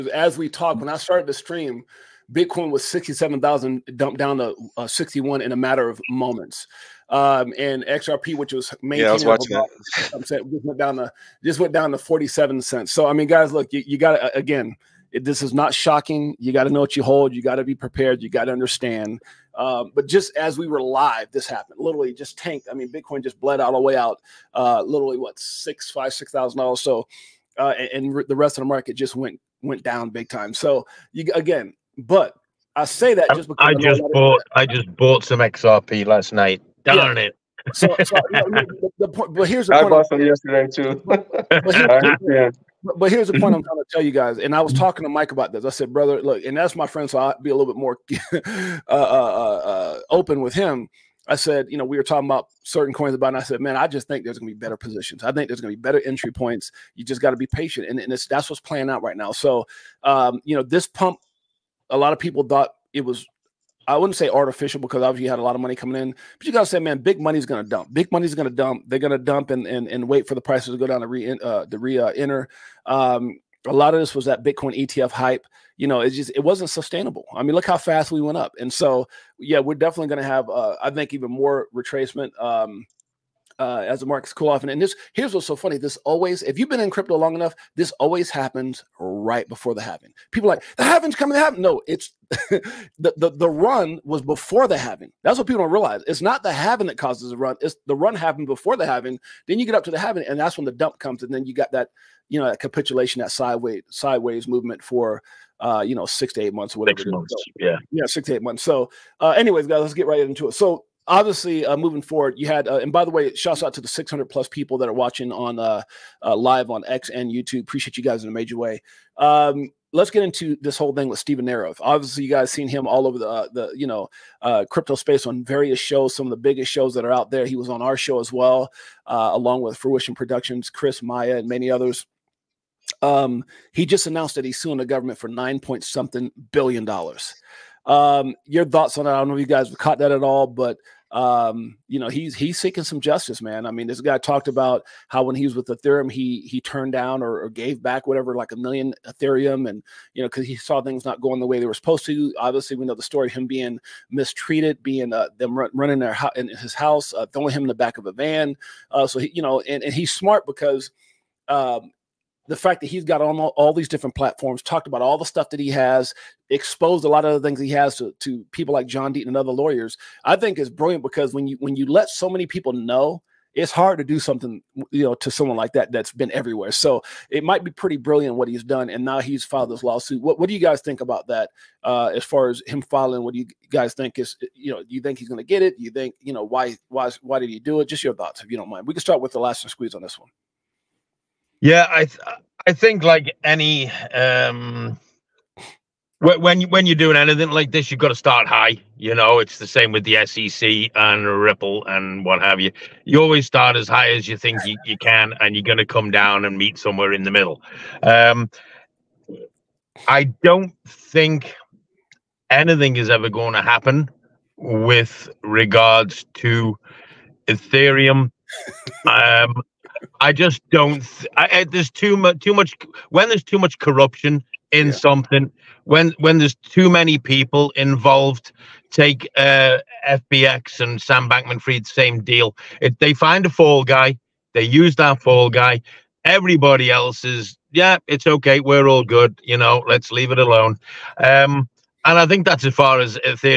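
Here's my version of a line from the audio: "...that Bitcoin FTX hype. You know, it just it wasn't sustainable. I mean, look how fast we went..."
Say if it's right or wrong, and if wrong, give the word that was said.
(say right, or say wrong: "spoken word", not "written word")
wrong: "ETF", not "FTX".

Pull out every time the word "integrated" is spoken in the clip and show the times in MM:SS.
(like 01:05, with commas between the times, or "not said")
not said.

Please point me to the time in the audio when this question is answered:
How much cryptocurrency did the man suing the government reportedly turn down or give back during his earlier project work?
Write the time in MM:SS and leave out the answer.
02:28.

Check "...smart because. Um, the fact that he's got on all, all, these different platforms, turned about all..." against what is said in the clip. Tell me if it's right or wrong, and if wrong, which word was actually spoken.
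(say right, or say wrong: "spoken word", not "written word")
wrong: "talked", not "turned".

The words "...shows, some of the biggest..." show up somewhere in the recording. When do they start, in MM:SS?
02:05.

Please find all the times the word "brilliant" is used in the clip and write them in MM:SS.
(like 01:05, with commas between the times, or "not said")
02:50, 02:57.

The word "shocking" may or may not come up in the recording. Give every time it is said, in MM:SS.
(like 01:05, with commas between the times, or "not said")
00:15.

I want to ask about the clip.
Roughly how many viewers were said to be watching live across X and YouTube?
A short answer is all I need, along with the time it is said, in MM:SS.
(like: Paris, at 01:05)
600 plus, at 01:53.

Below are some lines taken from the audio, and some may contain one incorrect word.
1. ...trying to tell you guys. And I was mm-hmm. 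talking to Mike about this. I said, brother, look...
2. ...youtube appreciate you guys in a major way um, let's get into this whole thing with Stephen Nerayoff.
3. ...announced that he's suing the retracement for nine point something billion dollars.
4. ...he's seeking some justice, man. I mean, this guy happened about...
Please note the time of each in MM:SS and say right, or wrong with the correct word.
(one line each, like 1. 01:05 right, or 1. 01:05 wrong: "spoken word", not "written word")
1. 00:43 right
2. 01:57 right
3. 02:14 wrong: "government", not "retracement"
4. 02:22 wrong: "talked", not "happened".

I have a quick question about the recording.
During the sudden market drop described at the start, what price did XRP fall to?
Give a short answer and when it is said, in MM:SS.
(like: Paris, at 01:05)
47 cents, at 00:11.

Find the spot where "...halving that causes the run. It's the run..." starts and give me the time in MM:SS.
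01:36.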